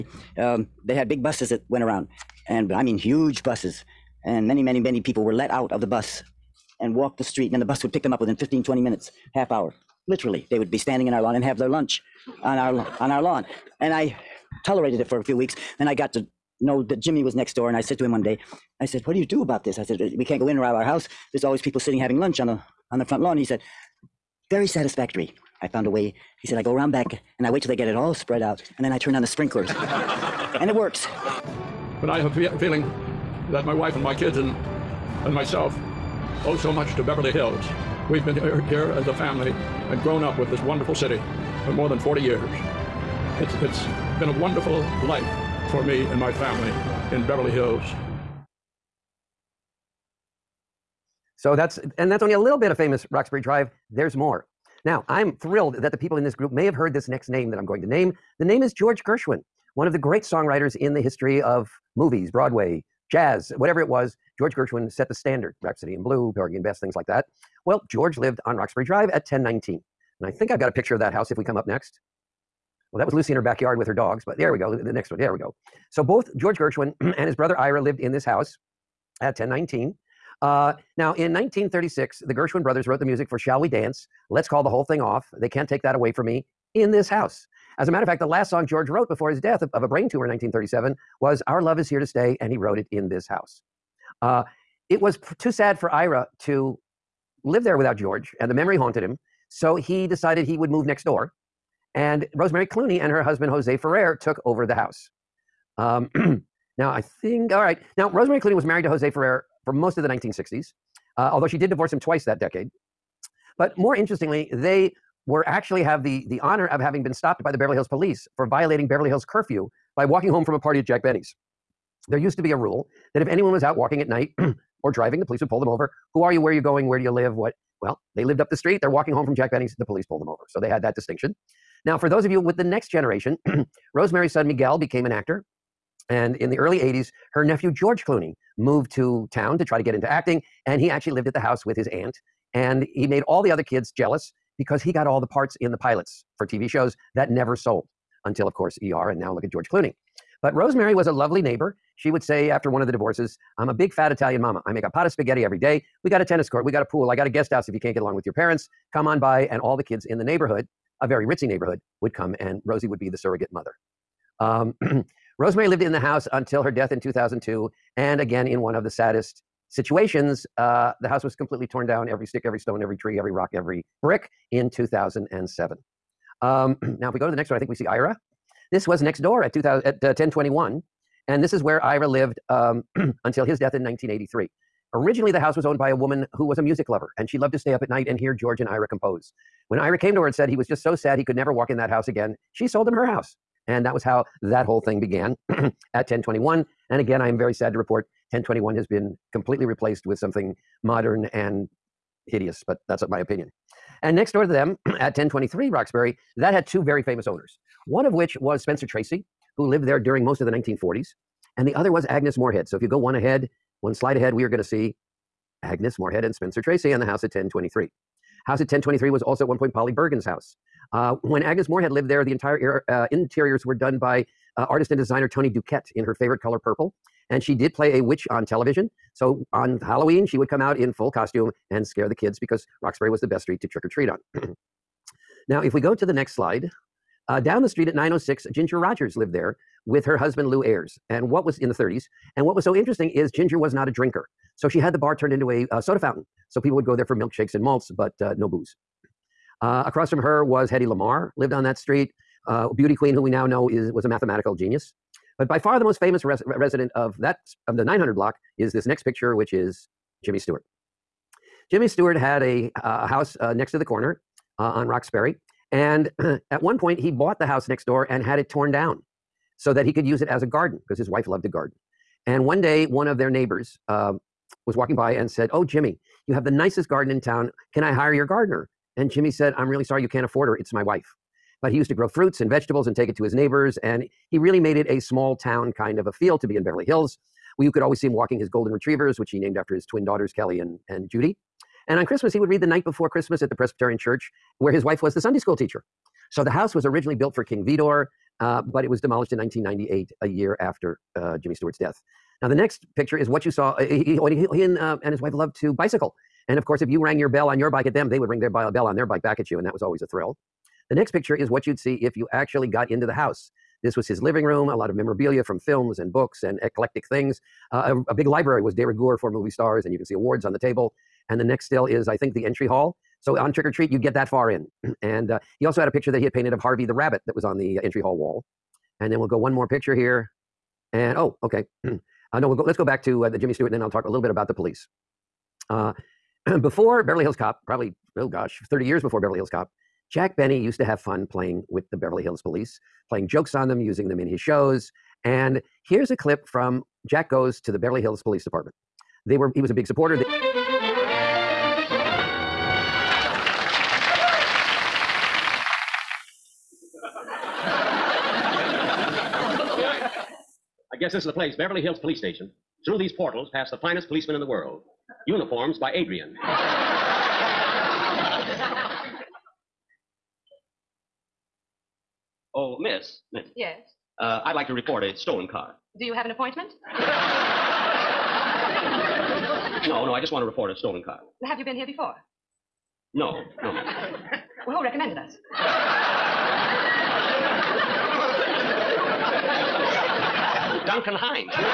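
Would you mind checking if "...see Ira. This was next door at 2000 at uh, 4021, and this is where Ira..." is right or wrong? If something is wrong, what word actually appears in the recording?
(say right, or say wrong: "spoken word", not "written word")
wrong: "1021", not "4021".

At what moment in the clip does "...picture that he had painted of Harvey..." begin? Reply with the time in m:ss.
5:25.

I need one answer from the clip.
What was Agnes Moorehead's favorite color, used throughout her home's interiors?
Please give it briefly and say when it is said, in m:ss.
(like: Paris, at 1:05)
Purple, at 3:46.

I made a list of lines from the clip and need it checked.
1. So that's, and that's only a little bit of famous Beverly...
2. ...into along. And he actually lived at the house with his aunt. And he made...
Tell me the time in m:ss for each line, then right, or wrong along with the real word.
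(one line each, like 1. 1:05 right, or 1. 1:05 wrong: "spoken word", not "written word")
1. 0:51 wrong: "Roxbury", not "Beverly"
2. 2:19 wrong: "acting", not "along".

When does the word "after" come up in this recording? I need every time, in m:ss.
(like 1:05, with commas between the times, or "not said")
2:32, 4:49, 5:00.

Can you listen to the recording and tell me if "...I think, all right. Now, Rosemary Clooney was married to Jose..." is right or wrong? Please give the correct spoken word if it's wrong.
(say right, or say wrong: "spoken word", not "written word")
right.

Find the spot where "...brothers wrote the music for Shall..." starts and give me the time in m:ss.
1:22.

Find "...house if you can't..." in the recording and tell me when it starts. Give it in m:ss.
2:37.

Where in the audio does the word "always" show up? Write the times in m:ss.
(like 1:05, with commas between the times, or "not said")
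0:21, 4:47, 5:09.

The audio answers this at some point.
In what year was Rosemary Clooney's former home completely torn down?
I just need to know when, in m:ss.
2:54.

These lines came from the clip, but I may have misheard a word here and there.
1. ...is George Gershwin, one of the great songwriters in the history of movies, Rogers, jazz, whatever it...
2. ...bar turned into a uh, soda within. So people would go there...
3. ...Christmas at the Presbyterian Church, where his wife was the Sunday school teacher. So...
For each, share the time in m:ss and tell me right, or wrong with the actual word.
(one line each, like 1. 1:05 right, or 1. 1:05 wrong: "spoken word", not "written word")
1. 0:58 wrong: "Broadway", not "Rogers"
2. 4:04 wrong: "fountain", not "within"
3. 4:53 right.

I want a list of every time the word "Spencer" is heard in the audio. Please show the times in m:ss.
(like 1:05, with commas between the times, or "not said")
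3:28, 3:36.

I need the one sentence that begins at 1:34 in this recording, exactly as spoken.
Uh, it was too sad for Ira to live there without George, and the memory haunted him.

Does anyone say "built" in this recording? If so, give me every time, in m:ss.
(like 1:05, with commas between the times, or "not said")
4:57.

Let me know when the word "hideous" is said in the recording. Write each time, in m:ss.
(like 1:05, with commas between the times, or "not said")
3:22.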